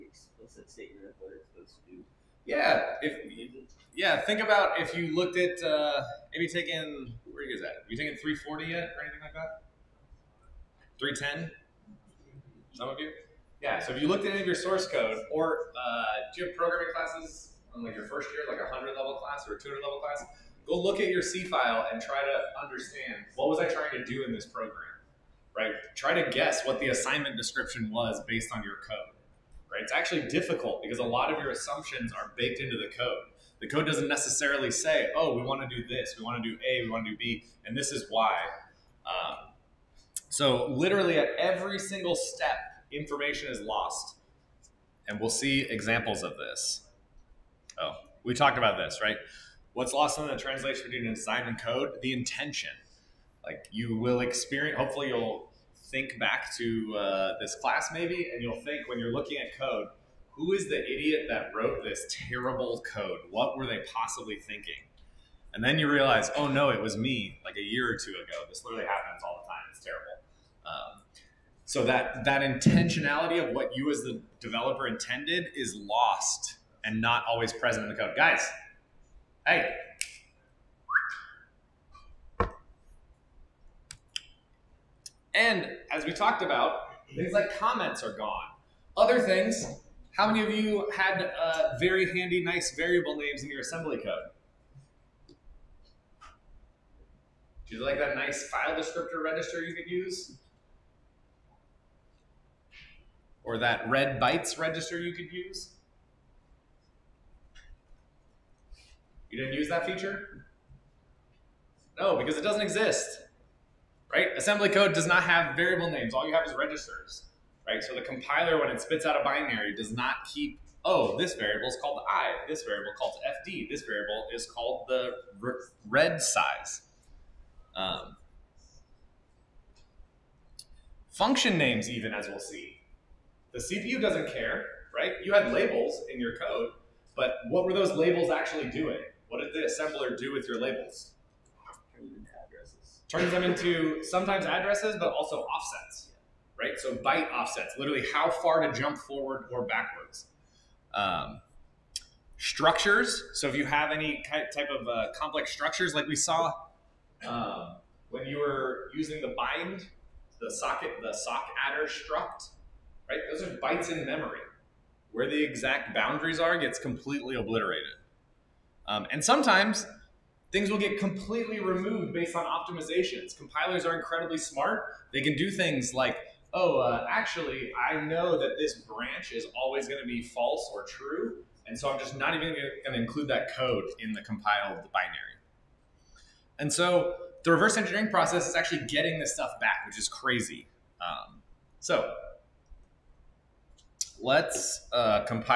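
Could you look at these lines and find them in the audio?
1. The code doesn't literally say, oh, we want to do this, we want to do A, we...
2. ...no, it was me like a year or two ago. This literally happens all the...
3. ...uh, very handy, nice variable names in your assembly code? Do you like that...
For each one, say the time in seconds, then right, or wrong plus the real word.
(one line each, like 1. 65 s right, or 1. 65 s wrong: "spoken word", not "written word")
1. 33 s wrong: "necessarily", not "literally"
2. 66 s right
3. 91 s right.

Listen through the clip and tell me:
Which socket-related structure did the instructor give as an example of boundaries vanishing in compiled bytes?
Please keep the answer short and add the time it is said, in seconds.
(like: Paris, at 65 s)
sock adder struct, at 161 s.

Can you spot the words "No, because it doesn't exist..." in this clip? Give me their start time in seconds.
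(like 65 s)
111 s.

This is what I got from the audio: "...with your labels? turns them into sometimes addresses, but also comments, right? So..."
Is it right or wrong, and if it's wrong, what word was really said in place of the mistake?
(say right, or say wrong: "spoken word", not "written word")
wrong: "offsets", not "comments".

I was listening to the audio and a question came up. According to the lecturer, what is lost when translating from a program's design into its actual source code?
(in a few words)
The intention.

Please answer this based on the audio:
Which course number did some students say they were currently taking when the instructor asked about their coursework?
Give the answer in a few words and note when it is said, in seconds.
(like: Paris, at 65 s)
310, at 10 s.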